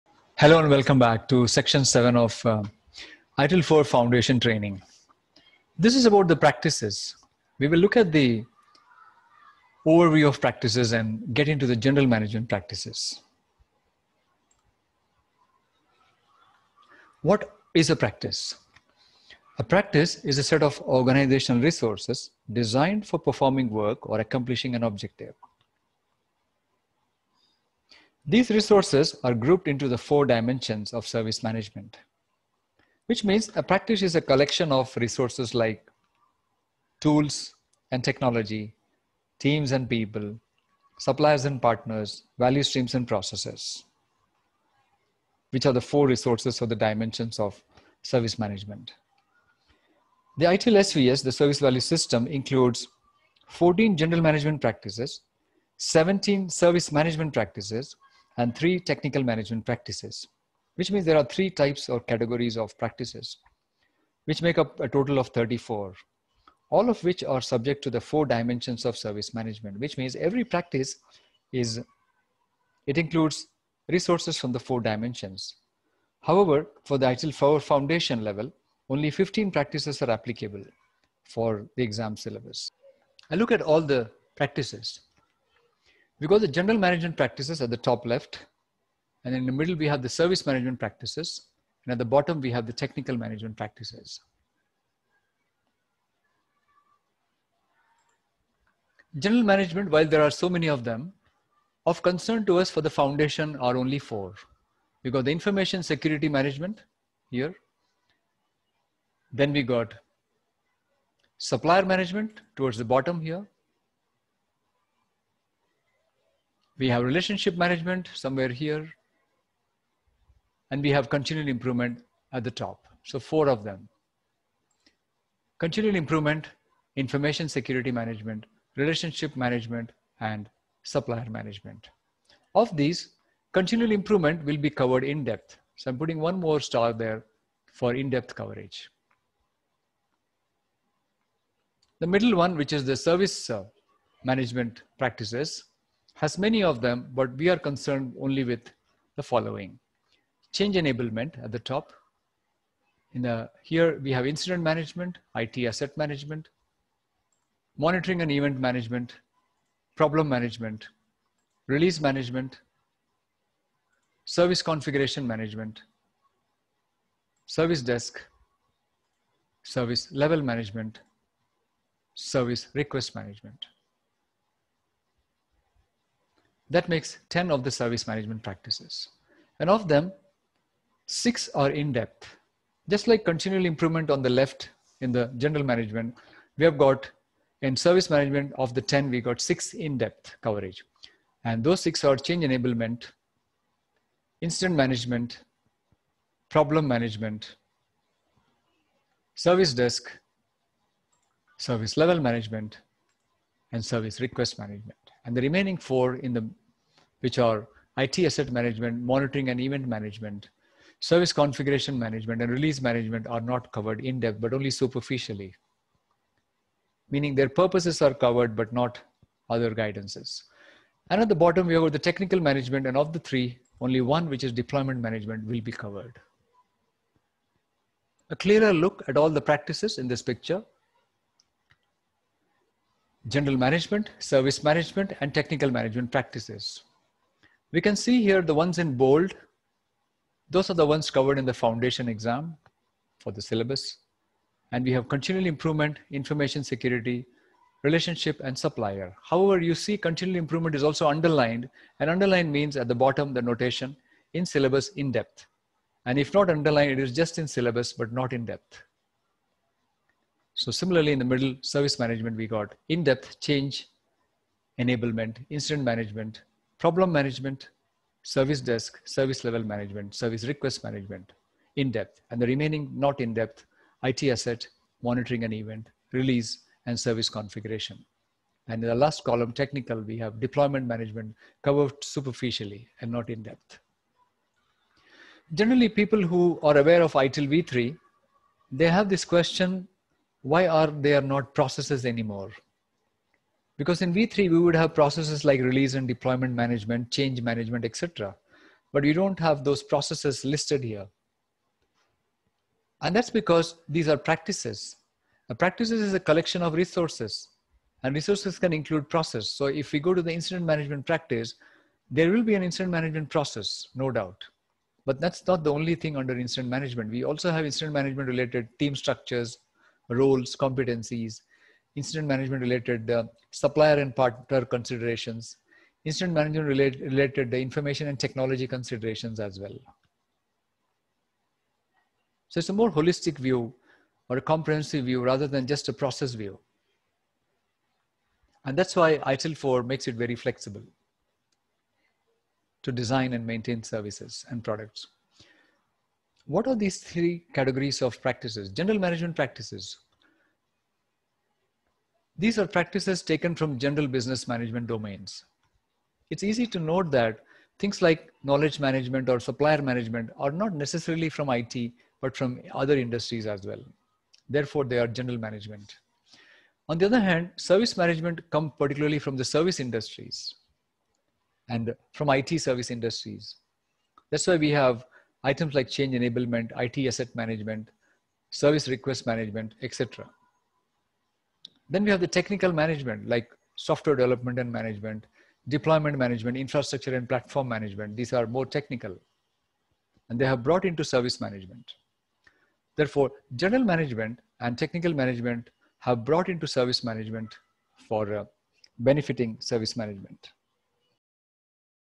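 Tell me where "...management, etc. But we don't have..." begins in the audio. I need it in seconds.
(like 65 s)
297 s.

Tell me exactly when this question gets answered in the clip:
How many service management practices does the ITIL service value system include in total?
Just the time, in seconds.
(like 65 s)
55 s.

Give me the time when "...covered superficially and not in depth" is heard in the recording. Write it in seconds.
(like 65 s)
281 s.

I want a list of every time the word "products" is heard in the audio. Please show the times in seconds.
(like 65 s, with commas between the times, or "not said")
344 s.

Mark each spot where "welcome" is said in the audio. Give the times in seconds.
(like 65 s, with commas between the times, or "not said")
0 s.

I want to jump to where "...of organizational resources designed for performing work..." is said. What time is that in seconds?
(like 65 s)
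20 s.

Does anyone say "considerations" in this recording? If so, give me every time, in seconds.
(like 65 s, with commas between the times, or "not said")
324 s, 328 s.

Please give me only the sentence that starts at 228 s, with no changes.
A clearer look at all the practices in this picture general management, service management, and technical management practices.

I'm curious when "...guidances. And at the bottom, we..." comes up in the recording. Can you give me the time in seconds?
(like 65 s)
219 s.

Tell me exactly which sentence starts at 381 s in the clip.
Then we have the technical management like software development and management, deployment management, infrastructure and platform management.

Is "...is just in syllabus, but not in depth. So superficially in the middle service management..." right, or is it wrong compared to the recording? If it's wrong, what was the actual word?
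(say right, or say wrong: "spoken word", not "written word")
wrong: "similarly", not "superficially".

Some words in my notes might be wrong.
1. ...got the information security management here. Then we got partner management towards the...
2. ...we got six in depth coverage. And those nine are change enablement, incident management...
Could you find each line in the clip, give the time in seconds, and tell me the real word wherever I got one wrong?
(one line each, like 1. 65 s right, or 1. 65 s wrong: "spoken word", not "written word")
1. 105 s wrong: "supplier", not "partner"
2. 189 s wrong: "six", not "nine".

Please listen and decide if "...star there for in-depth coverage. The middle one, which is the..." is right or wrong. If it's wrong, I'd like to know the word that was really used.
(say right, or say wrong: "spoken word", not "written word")
right.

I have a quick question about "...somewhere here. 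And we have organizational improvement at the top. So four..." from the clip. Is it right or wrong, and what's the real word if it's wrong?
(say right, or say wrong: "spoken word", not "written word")
wrong: "continual", not "organizational".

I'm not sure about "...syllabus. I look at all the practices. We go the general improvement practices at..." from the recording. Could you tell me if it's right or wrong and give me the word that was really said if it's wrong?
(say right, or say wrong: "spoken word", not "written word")
wrong: "management", not "improvement".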